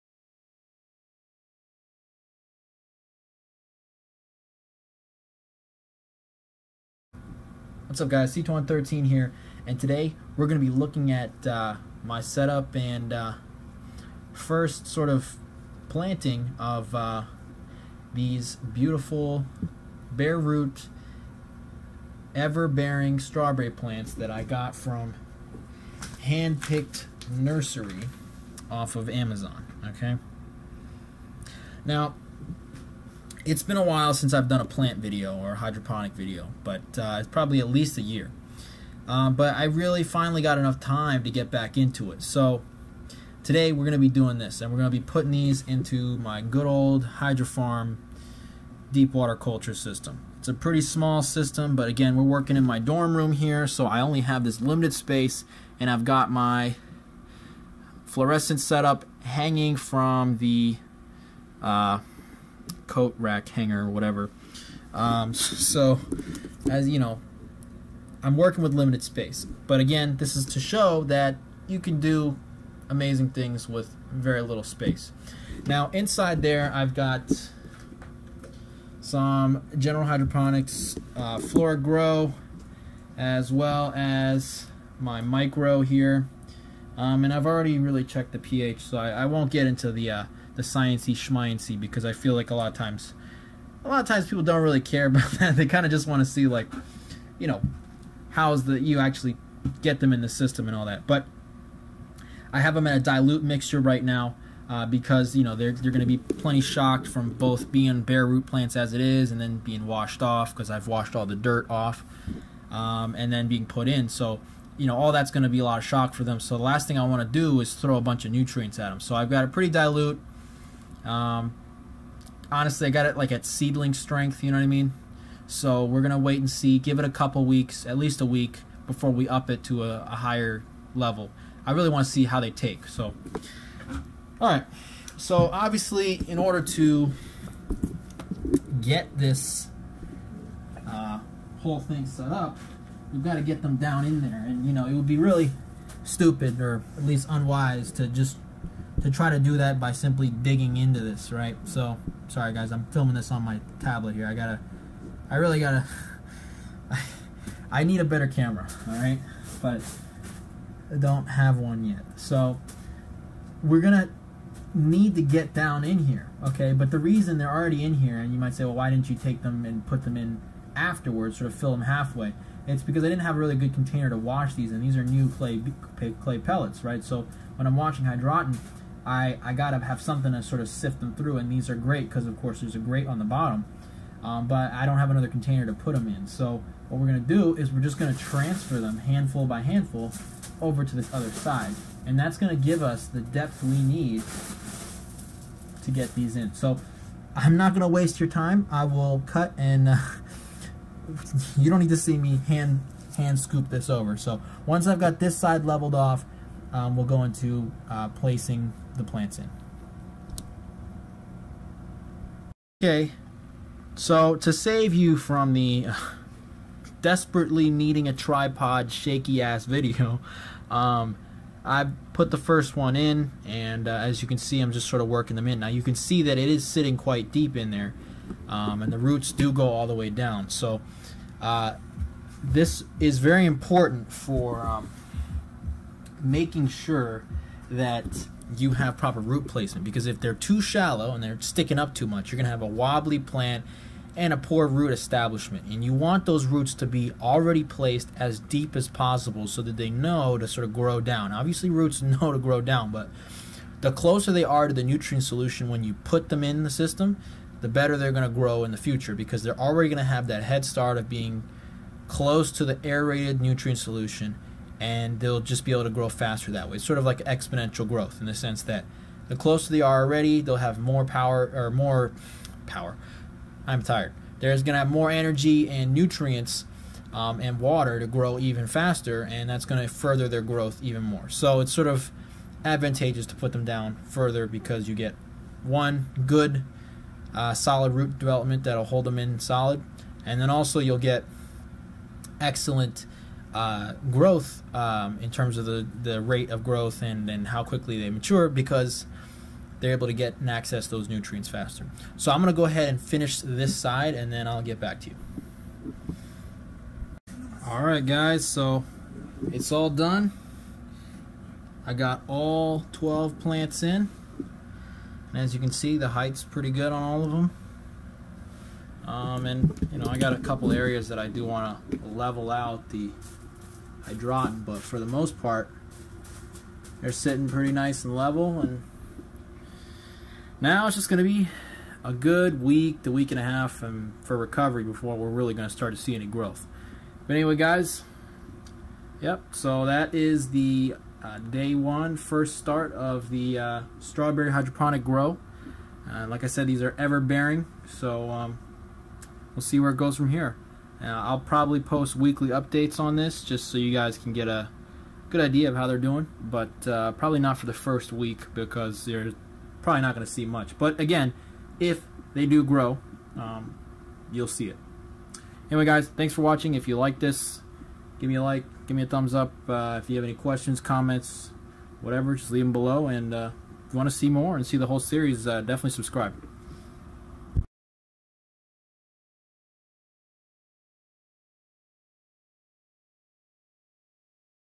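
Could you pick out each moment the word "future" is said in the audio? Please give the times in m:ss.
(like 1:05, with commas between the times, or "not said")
4:18.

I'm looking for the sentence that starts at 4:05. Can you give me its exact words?
And you want those roots to be already placed as deep as possible so that they know to sort of grow down.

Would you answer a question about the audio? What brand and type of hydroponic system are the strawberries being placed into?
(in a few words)
Hydrofarm deep water culture.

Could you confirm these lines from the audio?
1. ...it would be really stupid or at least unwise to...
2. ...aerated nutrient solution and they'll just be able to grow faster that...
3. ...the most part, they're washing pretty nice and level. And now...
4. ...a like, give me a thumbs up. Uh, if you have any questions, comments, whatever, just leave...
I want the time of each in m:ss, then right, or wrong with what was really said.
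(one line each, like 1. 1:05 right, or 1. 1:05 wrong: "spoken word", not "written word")
1. 2:24 right
2. 4:22 right
3. 5:24 wrong: "sitting", not "washing"
4. 6:08 right.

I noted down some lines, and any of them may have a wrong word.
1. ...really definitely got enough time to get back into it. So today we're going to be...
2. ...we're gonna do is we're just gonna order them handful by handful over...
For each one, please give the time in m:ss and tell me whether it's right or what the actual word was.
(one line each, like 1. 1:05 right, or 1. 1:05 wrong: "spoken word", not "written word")
1. 0:39 wrong: "finally", not "definitely"
2. 3:07 wrong: "transfer", not "order".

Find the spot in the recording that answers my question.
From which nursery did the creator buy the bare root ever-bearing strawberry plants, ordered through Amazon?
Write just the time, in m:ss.
0:26.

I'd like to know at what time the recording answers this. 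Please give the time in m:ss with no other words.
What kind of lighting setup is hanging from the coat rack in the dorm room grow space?
0:58.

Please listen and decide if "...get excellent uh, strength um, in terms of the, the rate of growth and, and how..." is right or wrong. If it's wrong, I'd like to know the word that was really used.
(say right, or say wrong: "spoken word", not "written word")
wrong: "growth", not "strength".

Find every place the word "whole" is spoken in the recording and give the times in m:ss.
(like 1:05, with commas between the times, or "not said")
2:21, 6:14.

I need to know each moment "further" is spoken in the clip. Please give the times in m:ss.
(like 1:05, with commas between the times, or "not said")
4:39, 4:44.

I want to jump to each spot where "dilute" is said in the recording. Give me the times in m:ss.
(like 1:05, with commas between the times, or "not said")
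1:42, 1:59.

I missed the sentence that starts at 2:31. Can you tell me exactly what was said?
So, sorry guys, I'm filming this on my tablet here.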